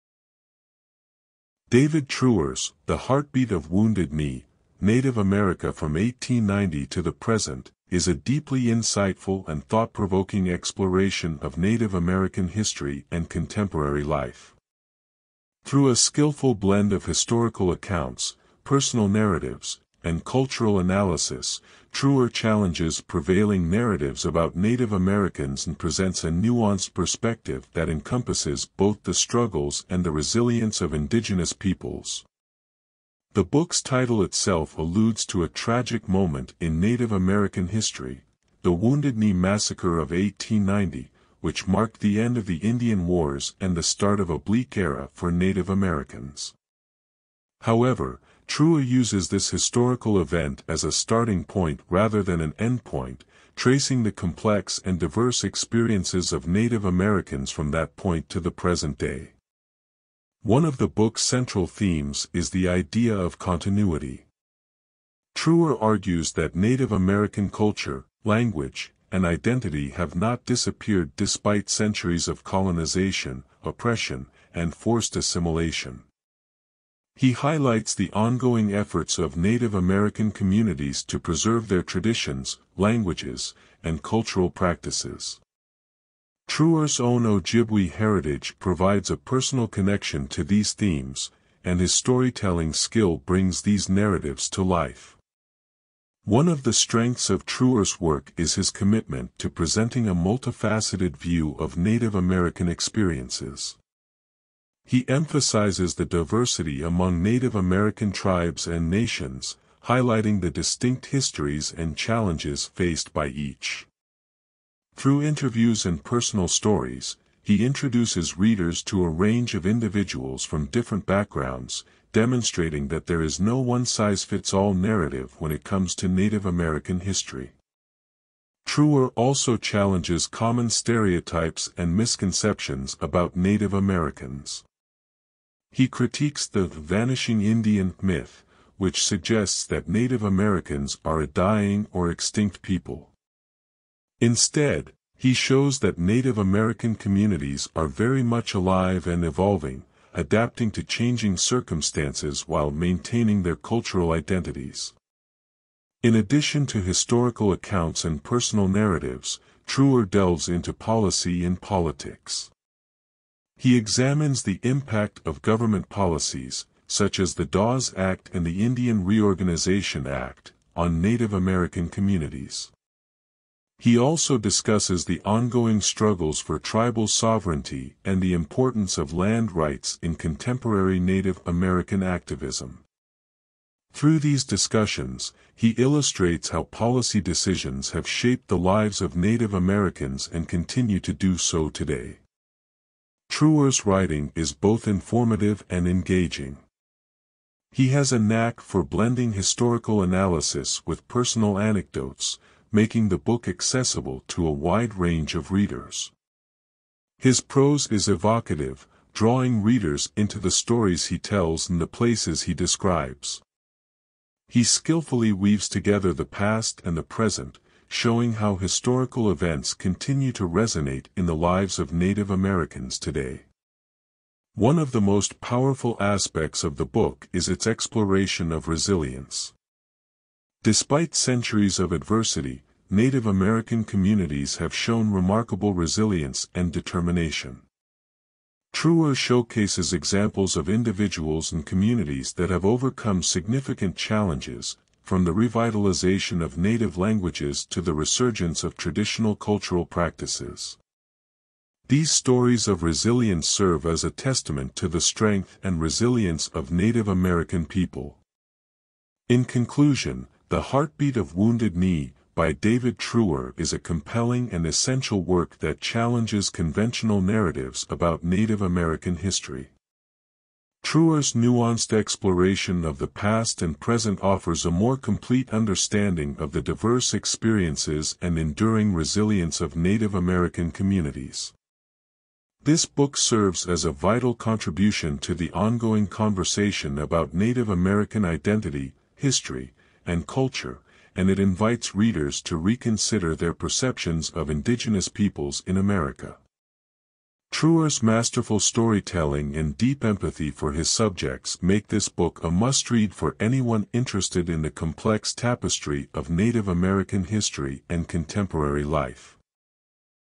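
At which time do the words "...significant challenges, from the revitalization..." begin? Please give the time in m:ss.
4:03.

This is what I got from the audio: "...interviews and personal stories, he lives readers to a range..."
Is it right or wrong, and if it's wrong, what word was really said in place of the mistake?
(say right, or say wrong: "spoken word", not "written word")
wrong: "introduces", not "lives".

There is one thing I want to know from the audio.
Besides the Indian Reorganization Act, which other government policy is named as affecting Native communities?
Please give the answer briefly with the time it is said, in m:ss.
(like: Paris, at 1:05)
the Dawes Act, at 2:47.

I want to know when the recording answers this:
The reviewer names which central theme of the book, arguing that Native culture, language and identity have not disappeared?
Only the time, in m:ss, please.
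1:03.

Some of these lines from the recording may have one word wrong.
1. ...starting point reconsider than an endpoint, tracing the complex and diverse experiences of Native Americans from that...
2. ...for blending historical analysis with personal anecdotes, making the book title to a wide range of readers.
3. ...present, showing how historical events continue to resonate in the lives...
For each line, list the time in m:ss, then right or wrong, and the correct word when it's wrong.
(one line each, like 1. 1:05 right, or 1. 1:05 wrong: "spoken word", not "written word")
1. 0:50 wrong: "rather", not "reconsider"
2. 3:18 wrong: "accessible", not "title"
3. 3:37 right.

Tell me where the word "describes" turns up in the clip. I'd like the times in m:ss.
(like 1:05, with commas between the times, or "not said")
3:32.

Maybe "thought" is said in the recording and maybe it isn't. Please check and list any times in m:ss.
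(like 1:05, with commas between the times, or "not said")
0:09.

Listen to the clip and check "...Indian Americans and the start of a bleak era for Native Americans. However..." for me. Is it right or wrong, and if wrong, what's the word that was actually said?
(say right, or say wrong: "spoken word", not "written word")
wrong: "Wars", not "Americans".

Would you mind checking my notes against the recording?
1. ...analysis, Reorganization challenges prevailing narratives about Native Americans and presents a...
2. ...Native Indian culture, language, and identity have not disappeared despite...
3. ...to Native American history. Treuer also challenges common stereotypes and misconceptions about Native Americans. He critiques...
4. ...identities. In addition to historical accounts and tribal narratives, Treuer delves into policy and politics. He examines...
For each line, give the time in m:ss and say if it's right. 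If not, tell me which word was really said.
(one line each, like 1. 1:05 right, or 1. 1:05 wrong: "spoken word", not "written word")
1. 0:20 wrong: "Treuer", not "Reorganization"
2. 1:06 wrong: "American", not "Indian"
3. 2:05 right
4. 2:34 wrong: "personal", not "tribal".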